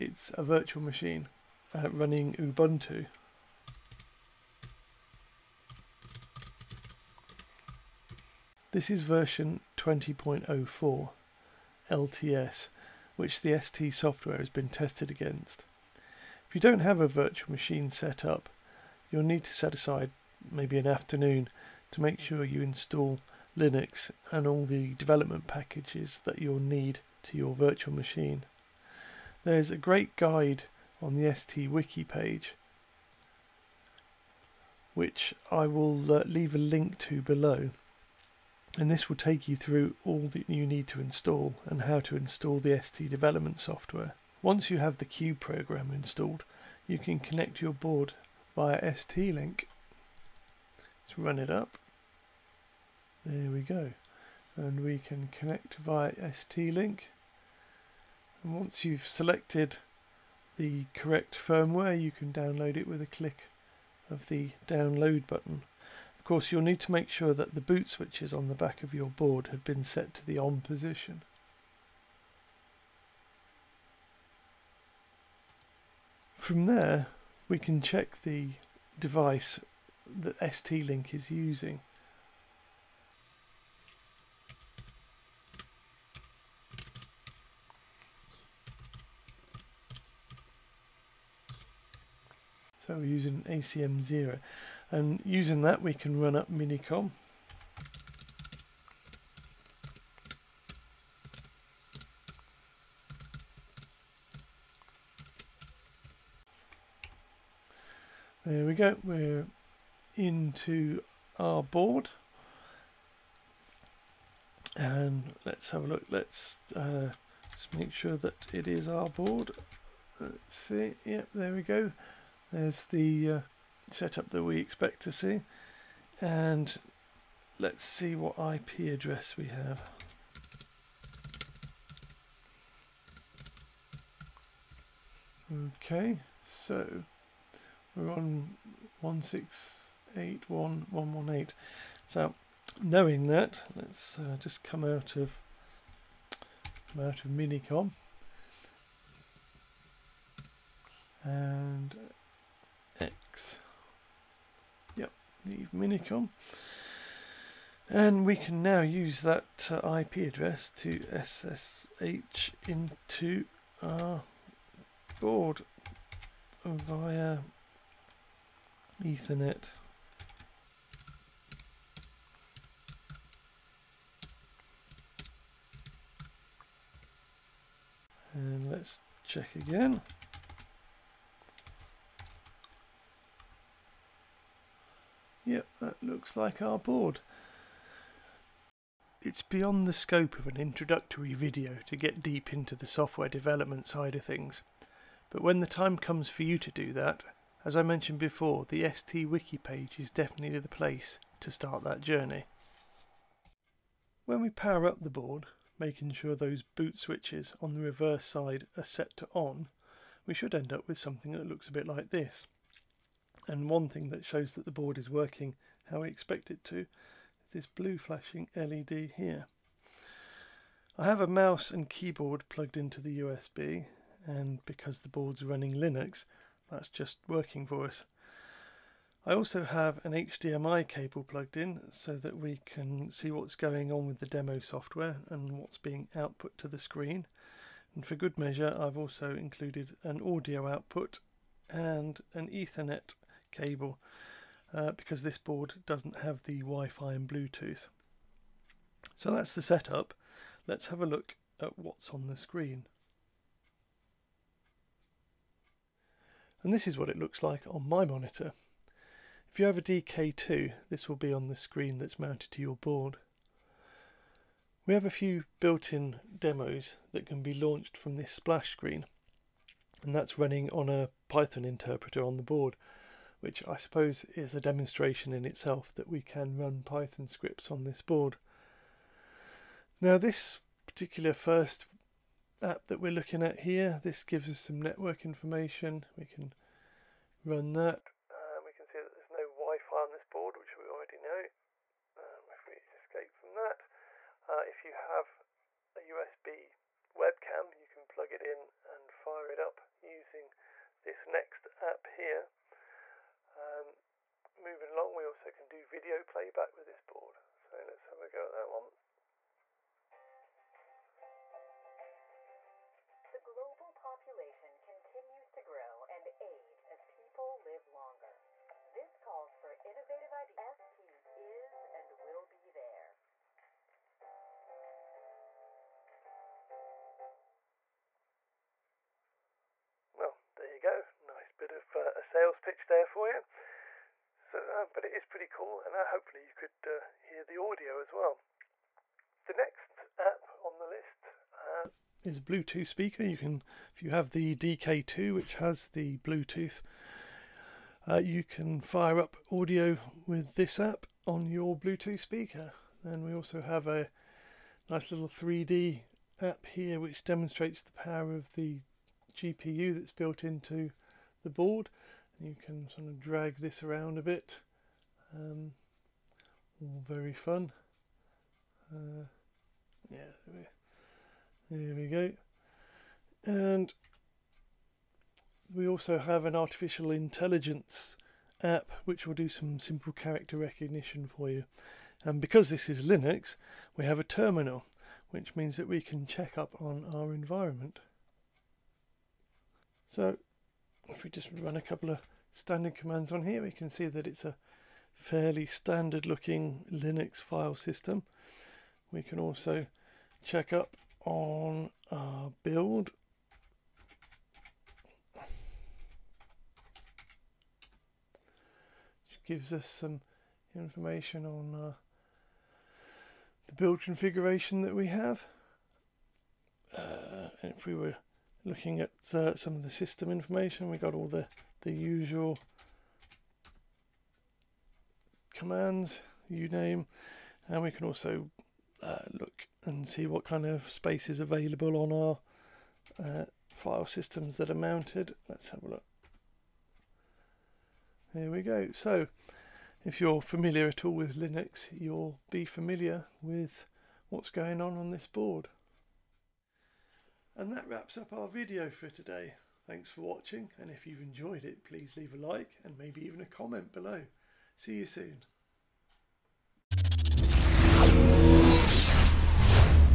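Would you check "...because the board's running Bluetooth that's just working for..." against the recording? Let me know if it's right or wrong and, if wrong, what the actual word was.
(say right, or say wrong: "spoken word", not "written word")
wrong: "Linux", not "Bluetooth".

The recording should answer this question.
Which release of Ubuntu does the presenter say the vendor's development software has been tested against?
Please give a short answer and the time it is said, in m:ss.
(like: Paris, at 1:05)
20.04 LTS, at 0:09.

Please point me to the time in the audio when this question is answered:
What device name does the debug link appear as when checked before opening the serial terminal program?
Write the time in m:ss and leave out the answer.
1:33.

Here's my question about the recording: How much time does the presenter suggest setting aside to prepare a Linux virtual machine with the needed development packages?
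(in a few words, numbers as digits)
an afternoon.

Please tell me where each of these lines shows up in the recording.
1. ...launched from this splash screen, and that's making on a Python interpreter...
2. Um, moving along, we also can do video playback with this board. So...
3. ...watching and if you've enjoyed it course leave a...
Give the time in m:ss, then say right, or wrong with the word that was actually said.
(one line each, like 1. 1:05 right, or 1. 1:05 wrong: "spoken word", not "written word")
1. 4:27 wrong: "running", not "making"
2. 5:03 right
3. 7:30 wrong: "please", not "course".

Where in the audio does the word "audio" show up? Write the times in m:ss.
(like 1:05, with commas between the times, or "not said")
4:00, 5:37, 5:49.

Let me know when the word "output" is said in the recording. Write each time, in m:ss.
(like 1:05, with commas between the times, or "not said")
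3:56, 4:00.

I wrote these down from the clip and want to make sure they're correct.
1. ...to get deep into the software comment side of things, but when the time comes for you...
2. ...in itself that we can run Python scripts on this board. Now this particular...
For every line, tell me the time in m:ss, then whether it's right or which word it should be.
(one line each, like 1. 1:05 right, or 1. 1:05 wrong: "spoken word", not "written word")
1. 3:11 wrong: "development", not "comment"
2. 4:35 right.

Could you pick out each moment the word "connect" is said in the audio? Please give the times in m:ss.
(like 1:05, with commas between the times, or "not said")
0:47, 0:55.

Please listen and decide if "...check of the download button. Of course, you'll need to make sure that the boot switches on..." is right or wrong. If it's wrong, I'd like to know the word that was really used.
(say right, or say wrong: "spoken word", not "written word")
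wrong: "click", not "check".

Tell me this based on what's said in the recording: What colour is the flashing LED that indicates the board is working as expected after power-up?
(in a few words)
Blue.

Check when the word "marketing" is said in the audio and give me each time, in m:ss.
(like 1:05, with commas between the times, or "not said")
not said.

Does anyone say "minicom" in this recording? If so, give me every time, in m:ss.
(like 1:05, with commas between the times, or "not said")
1:36, 2:27, 2:35.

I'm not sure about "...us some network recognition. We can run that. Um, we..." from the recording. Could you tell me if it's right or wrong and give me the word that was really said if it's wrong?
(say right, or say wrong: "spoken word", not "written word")
wrong: "information", not "recognition".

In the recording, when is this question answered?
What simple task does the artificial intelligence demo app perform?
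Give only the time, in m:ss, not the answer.
6:20.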